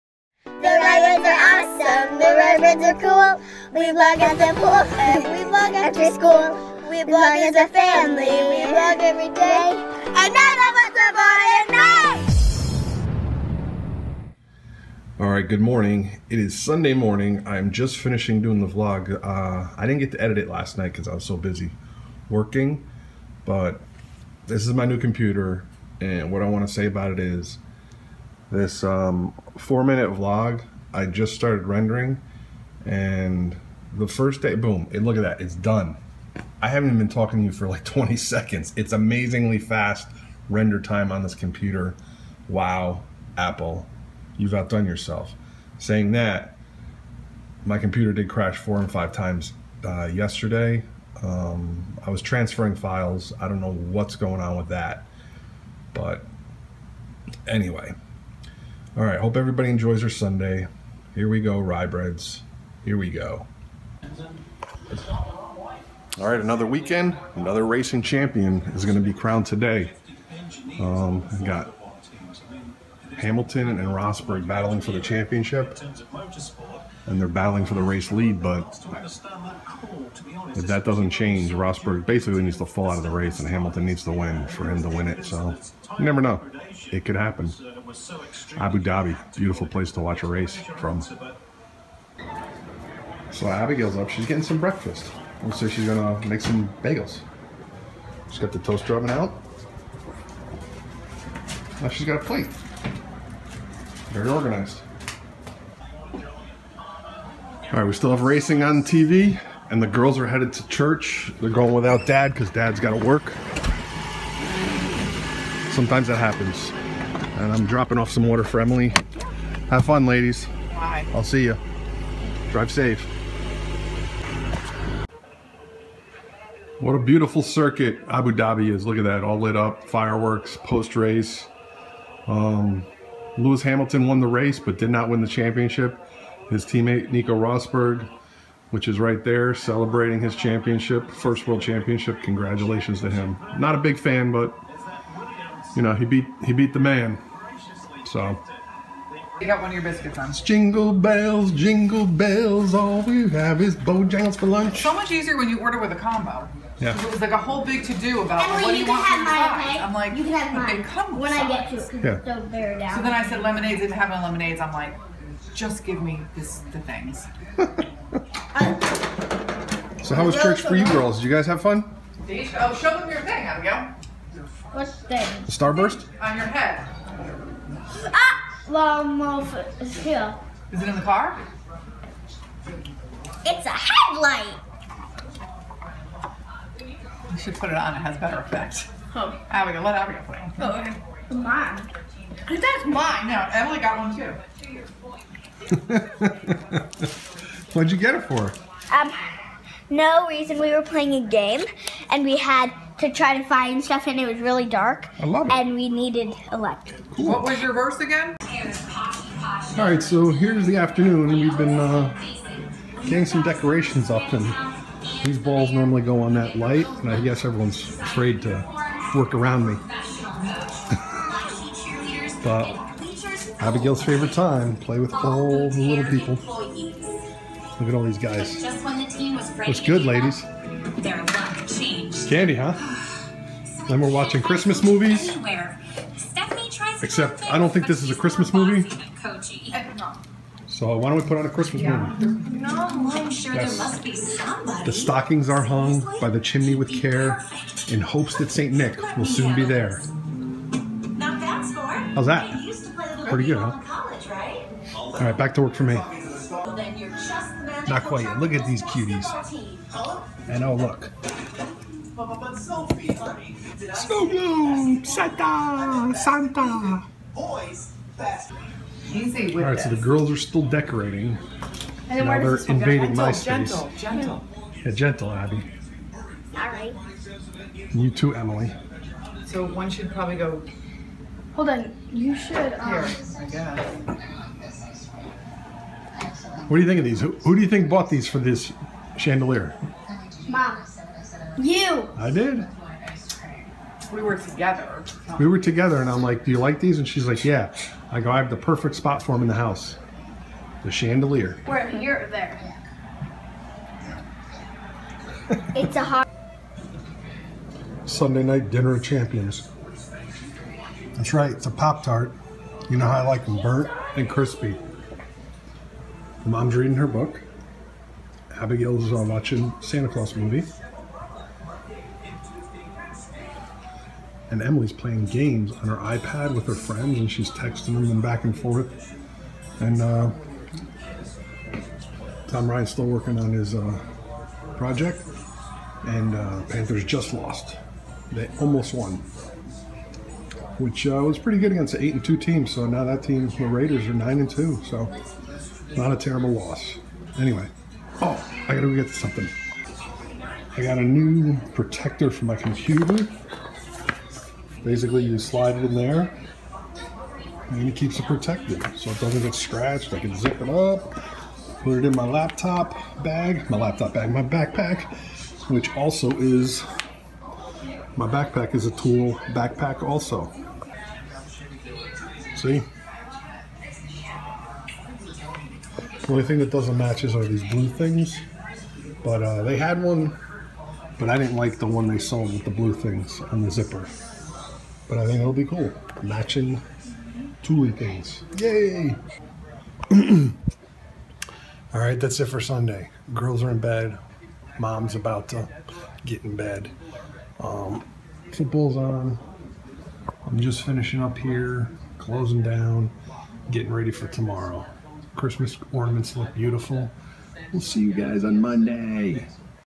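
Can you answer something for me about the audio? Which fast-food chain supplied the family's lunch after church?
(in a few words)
Bojangles.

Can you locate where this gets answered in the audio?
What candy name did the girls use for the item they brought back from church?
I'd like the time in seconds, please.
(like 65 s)
175 s.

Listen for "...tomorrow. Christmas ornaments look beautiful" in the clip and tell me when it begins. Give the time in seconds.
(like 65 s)
404 s.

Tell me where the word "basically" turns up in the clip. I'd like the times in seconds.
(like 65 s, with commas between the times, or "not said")
82 s, 354 s.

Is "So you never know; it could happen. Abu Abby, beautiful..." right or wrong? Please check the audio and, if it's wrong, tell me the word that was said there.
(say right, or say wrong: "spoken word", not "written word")
wrong: "Dhabi", not "Abby".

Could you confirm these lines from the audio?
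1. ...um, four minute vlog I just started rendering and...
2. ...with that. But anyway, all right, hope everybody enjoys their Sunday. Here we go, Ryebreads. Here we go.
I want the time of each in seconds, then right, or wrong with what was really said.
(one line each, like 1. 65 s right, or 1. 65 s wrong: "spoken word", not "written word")
1. 28 s right
2. 54 s right.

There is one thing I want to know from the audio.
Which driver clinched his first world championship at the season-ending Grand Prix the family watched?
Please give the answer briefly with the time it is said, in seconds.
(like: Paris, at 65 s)
Nico Rosberg, at 137 s.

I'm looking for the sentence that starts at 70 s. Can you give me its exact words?
Um, got Hamilton and Rosberg battling for the championship, and they're battling for the race lead.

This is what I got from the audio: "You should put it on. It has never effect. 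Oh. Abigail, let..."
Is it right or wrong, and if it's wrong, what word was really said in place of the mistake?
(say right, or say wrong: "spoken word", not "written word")
wrong: "better", not "never".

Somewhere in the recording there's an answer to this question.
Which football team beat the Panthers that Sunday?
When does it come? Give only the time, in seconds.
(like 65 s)
343 s.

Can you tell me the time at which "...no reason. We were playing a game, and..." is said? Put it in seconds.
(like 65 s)
199 s.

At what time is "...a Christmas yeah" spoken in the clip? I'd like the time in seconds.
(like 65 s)
241 s.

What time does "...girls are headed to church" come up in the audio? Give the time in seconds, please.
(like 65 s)
109 s.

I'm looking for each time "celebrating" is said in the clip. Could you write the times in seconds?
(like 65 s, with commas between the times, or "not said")
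139 s.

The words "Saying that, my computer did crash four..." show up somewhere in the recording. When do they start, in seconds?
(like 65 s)
45 s.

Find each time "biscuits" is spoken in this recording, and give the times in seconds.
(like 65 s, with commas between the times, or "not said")
149 s.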